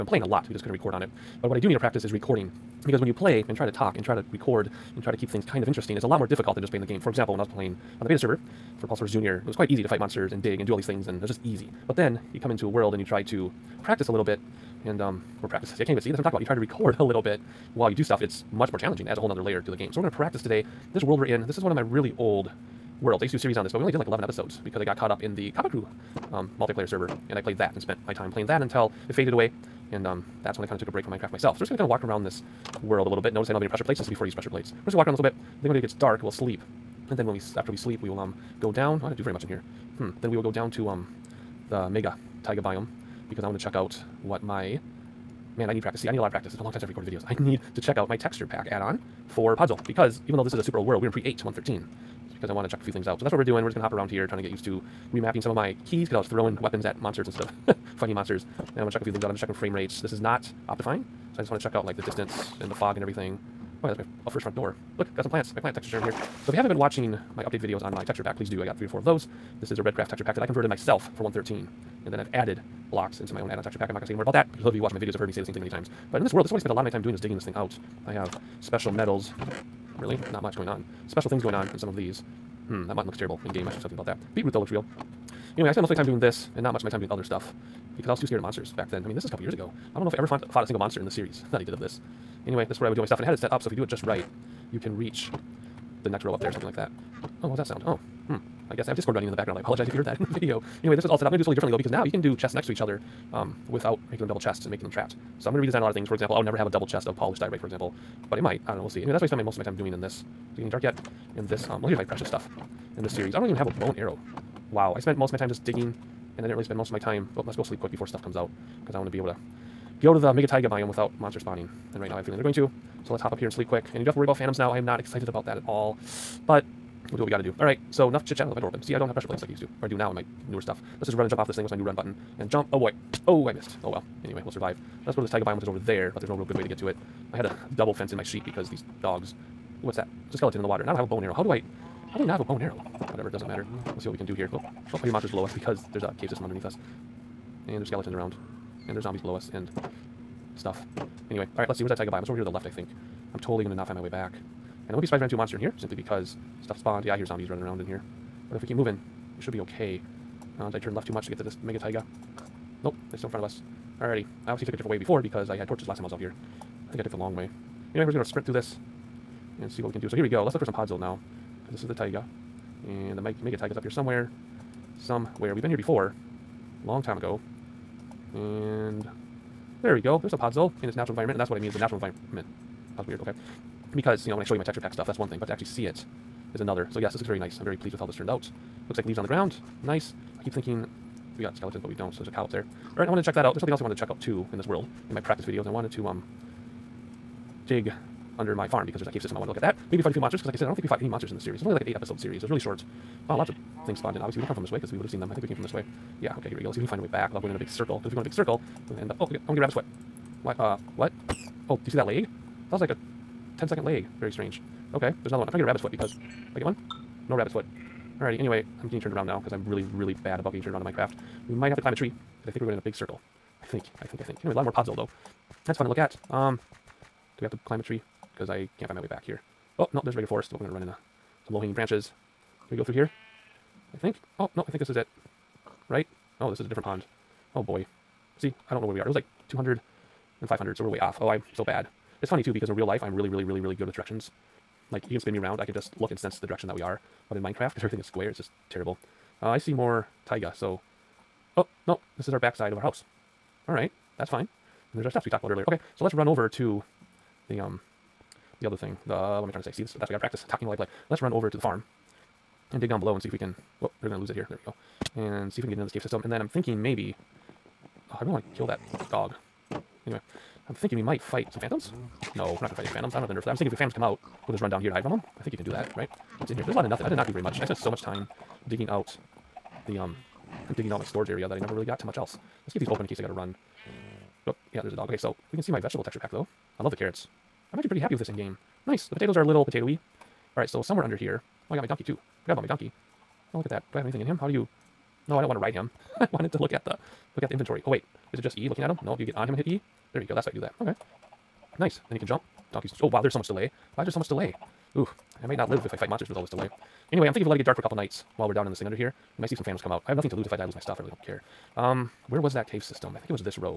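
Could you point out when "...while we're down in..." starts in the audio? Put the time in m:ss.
5:08.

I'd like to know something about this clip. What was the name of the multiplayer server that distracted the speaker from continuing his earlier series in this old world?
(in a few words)
Coppah Crew.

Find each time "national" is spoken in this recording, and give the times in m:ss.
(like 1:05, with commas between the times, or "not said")
not said.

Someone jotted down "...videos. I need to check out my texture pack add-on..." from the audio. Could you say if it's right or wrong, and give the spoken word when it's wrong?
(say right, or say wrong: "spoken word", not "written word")
right.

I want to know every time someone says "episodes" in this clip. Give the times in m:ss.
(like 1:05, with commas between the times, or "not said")
0:24, 3:21.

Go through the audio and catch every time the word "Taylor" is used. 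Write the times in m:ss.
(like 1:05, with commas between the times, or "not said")
not said.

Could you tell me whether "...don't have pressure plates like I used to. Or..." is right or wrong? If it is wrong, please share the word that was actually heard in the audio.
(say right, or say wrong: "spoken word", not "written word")
right.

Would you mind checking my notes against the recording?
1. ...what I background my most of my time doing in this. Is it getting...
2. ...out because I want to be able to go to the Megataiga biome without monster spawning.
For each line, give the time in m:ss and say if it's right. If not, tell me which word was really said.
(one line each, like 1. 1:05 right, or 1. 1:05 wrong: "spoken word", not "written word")
1. 1:49 wrong: "spend", not "background"
2. 1:58 right.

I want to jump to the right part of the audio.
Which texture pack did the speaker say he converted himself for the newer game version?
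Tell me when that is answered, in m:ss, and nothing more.
1:09.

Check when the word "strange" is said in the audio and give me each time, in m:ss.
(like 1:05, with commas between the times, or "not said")
3:34.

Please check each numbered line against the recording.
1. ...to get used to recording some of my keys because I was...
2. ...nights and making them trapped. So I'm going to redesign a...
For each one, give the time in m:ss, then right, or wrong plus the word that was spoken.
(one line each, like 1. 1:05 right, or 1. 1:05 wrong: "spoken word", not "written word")
1. 0:54 wrong: "remapping", not "recording"
2. 1:44 wrong: "chests", not "nights".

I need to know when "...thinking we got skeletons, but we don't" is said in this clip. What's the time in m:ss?
3:10.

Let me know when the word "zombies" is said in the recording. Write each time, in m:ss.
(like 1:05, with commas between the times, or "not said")
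2:29, 2:37.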